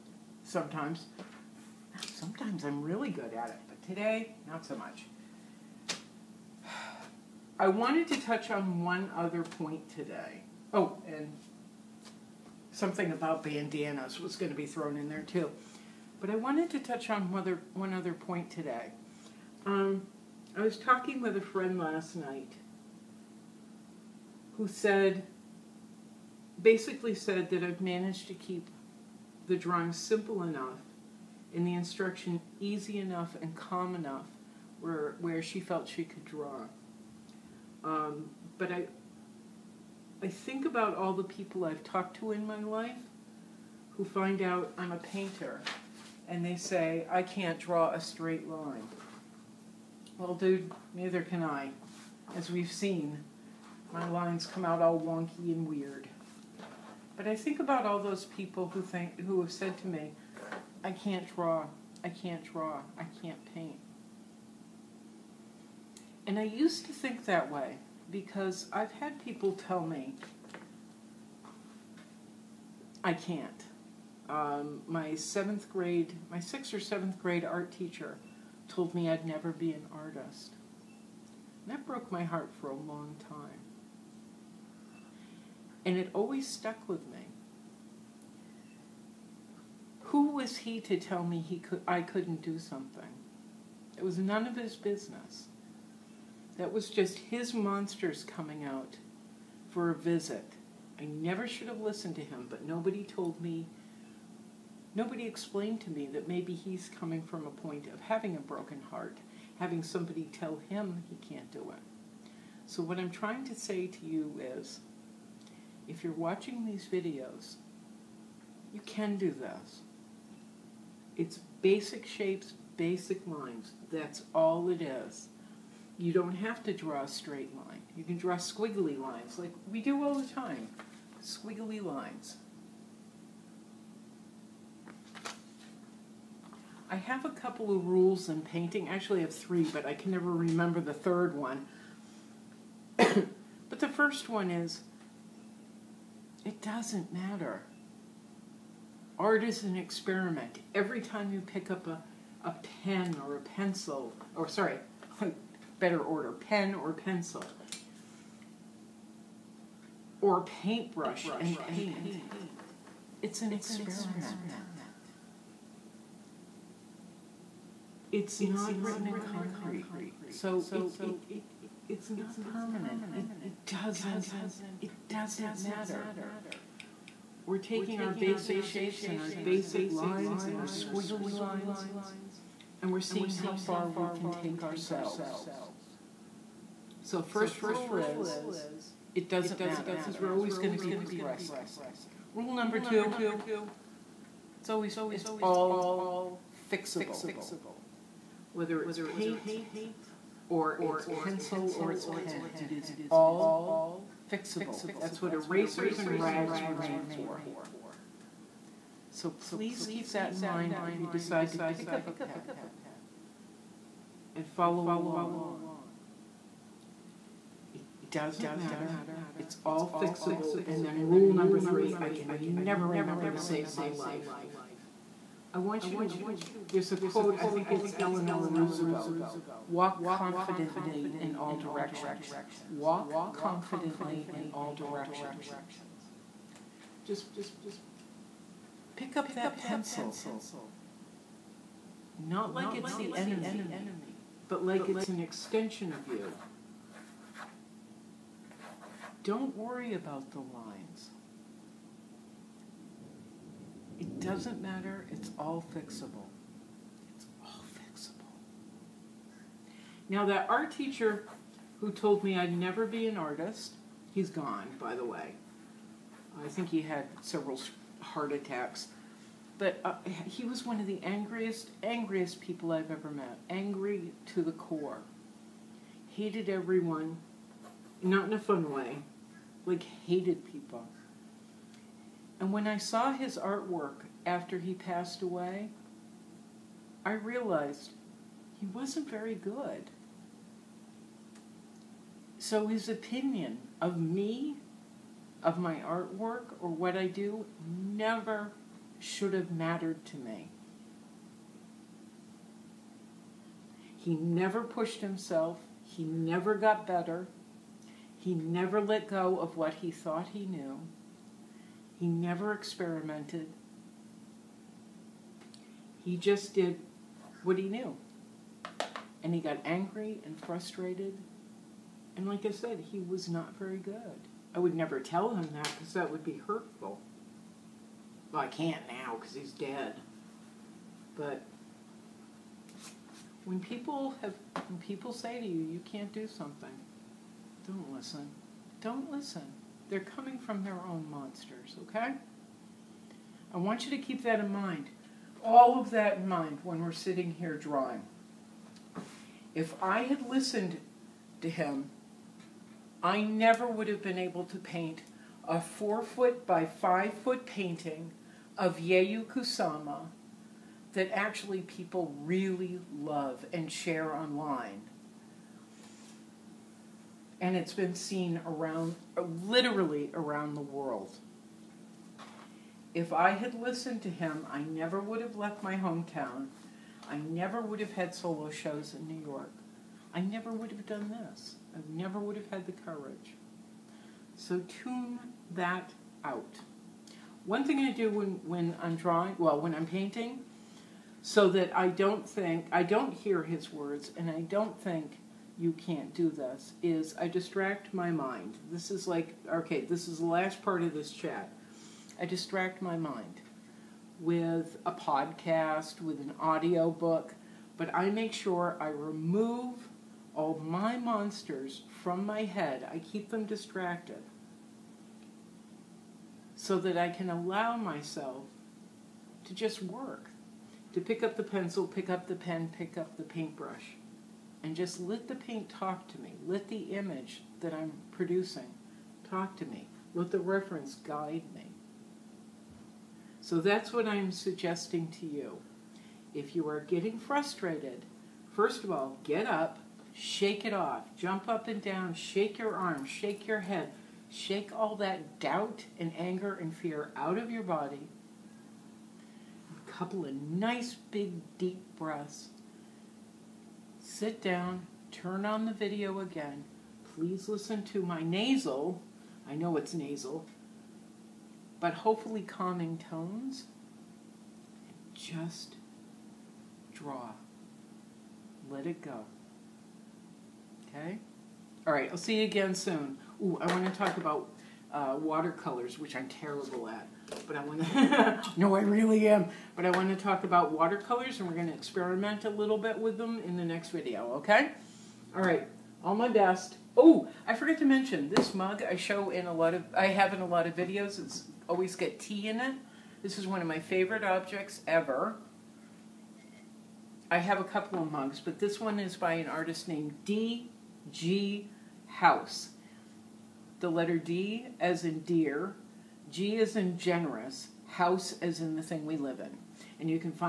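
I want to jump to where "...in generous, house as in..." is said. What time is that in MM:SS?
08:26.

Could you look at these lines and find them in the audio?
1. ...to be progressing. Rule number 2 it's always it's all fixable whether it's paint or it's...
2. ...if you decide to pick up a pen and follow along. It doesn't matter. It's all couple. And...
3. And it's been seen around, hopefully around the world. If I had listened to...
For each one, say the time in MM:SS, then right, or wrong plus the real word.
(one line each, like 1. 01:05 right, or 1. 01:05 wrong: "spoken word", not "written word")
1. 03:10 right
2. 03:30 wrong: "fixable", not "couple"
3. 06:07 wrong: "literally", not "hopefully".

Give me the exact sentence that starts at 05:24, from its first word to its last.
I would never tell him that because that would be hurtful.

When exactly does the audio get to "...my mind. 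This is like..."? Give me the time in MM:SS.
06:37.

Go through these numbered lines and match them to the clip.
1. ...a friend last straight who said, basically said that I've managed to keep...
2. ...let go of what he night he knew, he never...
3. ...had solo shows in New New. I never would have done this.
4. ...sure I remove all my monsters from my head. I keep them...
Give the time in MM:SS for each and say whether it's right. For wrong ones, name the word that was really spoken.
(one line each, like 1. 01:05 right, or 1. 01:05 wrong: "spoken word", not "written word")
1. 00:21 wrong: "night", not "straight"
2. 05:08 wrong: "thought", not "night"
3. 06:17 wrong: "York", not "New"
4. 06:48 right.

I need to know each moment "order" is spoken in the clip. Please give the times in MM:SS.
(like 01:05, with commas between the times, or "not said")
02:35.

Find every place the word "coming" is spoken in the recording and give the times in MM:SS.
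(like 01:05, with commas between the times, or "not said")
01:38, 01:46, 05:39.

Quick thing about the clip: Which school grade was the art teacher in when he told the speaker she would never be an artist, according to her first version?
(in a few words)
sixth or seventh grade.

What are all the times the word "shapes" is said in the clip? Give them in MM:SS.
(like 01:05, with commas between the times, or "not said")
02:02, 02:58.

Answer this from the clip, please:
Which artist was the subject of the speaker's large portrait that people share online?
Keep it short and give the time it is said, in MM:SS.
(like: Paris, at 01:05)
Yayoi Kusama, at 05:58.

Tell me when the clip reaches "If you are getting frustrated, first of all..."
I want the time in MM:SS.
07:16.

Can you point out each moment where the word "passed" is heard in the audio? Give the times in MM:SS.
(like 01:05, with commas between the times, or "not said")
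04:44.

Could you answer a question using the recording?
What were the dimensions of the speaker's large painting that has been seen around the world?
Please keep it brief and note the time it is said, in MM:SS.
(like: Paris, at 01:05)
4 foot by 5 foot, at 05:55.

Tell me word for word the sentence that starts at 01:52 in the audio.
So, what I'm trying to say to you is if you're watching these videos, you can do this.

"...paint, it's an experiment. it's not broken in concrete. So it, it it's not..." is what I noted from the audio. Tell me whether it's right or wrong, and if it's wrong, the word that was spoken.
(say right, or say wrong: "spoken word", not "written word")
wrong: "written", not "broken".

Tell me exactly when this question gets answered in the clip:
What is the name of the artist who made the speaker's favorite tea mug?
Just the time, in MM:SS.
08:20.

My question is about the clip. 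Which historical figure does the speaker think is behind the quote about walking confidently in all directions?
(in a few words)
Eleanor Roosevelt.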